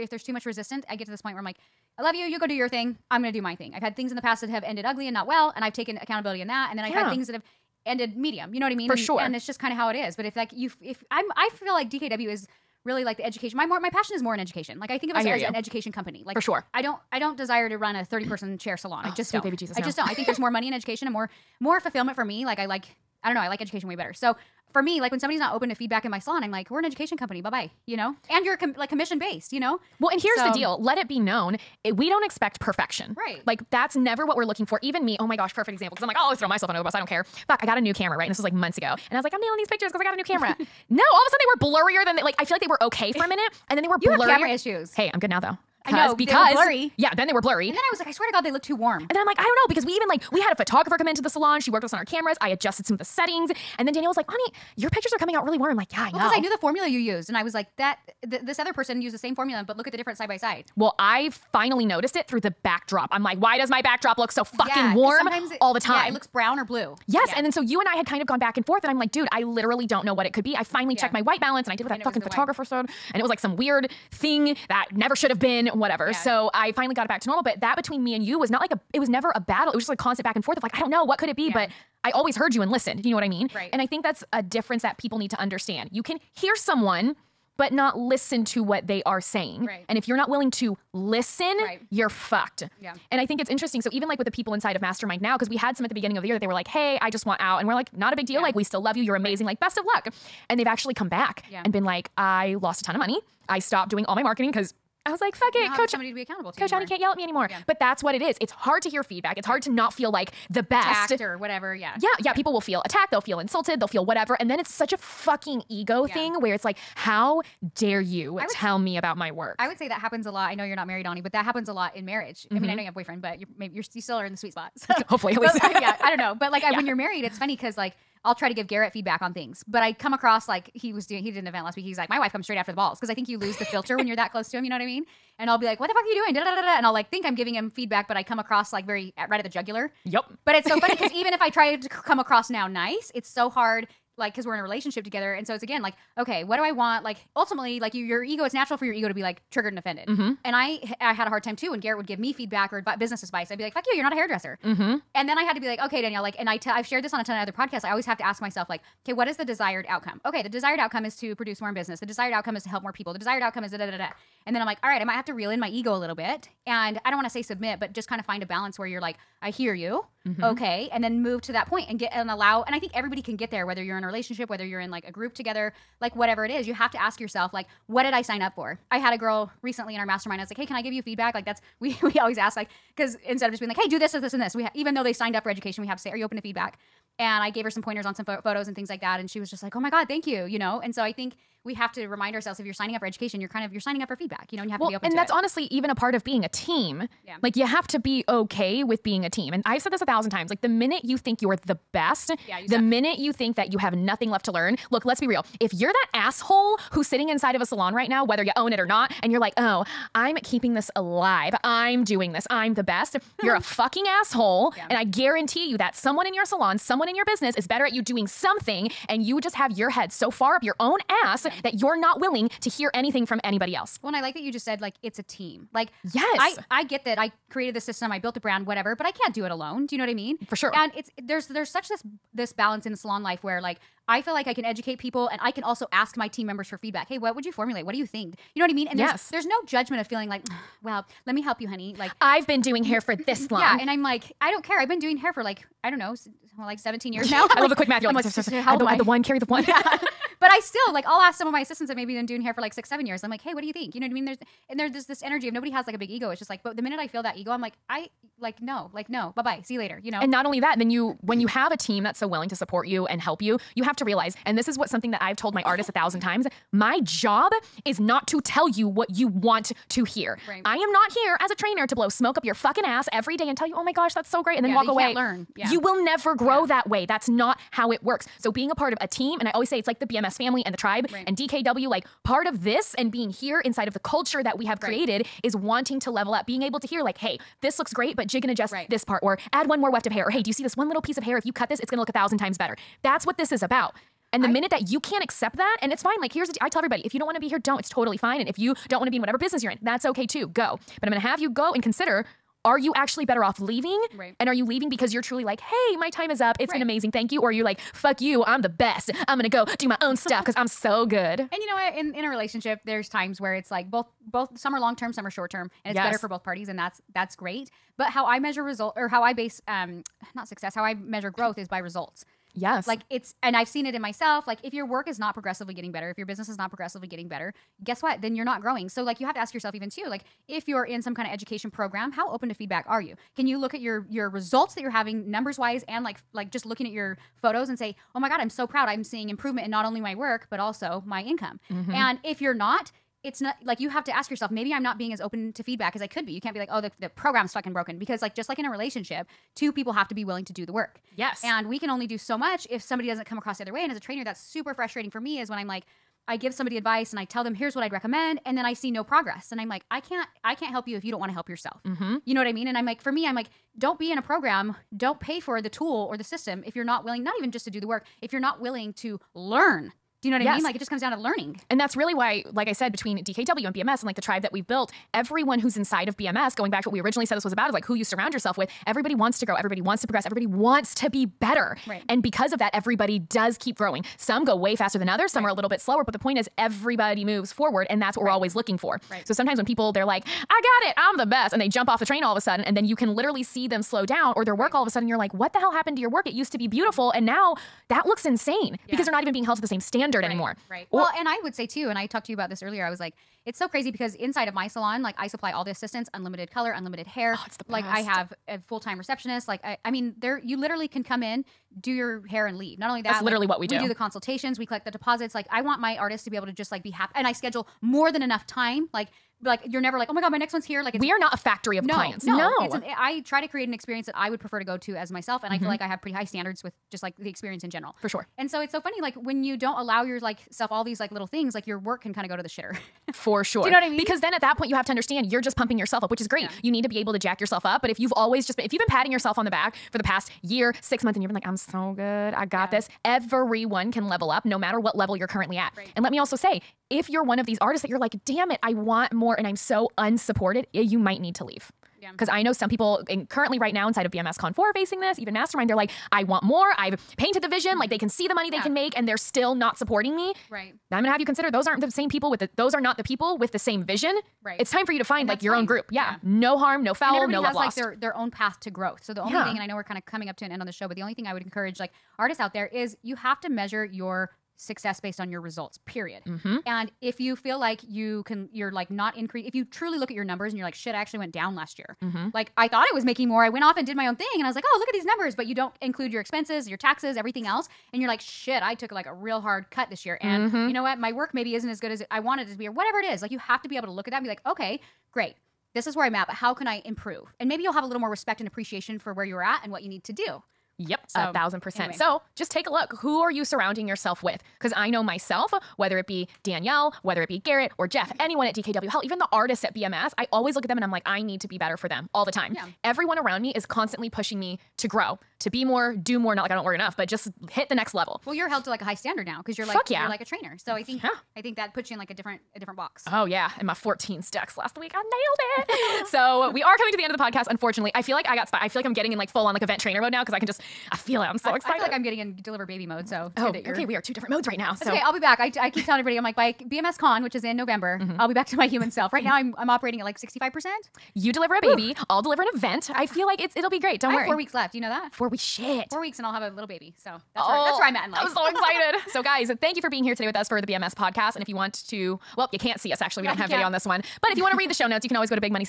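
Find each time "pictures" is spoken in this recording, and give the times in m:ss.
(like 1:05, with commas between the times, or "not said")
0:39, 0:54.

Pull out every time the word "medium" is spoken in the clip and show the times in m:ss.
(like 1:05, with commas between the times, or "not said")
0:08.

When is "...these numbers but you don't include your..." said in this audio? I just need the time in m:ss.
8:04.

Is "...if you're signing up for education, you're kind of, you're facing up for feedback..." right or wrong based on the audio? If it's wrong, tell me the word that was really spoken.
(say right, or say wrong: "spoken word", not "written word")
wrong: "signing", not "facing".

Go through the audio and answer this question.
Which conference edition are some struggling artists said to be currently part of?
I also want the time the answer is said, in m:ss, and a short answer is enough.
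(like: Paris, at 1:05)
BMS Con 4, at 7:34.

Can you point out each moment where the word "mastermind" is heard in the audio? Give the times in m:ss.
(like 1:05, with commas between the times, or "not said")
1:34, 3:00, 7:35.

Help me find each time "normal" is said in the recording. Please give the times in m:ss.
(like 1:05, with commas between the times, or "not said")
1:17.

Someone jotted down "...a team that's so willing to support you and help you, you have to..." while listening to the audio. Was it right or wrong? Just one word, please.
right.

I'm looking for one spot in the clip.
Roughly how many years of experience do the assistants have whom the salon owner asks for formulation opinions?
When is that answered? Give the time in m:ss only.
4:12.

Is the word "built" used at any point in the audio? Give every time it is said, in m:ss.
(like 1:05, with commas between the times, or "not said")
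3:48, 6:14.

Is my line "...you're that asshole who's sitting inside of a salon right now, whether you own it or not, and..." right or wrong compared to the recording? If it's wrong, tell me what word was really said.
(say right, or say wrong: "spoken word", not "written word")
right.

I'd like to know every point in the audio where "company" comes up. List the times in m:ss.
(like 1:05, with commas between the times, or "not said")
0:15, 0:27.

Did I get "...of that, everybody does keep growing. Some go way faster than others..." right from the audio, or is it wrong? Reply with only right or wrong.
right.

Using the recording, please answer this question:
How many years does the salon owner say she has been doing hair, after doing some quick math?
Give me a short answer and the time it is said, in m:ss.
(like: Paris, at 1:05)
17, at 4:06.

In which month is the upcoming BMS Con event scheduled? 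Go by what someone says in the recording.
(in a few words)
November.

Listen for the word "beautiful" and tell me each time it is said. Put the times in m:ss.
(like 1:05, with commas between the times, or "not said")
6:36.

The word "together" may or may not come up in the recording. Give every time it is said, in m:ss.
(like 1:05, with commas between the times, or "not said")
2:25, 2:55.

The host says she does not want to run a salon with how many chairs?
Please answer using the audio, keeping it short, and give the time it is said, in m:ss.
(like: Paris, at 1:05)
30, at 0:18.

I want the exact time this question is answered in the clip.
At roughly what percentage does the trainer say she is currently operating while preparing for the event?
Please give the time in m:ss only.
9:00.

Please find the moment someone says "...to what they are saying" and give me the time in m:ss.
1:28.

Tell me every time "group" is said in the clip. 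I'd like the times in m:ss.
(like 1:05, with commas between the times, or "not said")
2:55, 7:45.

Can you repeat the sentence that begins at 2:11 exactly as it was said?
He did an event last week.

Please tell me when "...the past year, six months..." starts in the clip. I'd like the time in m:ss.
7:19.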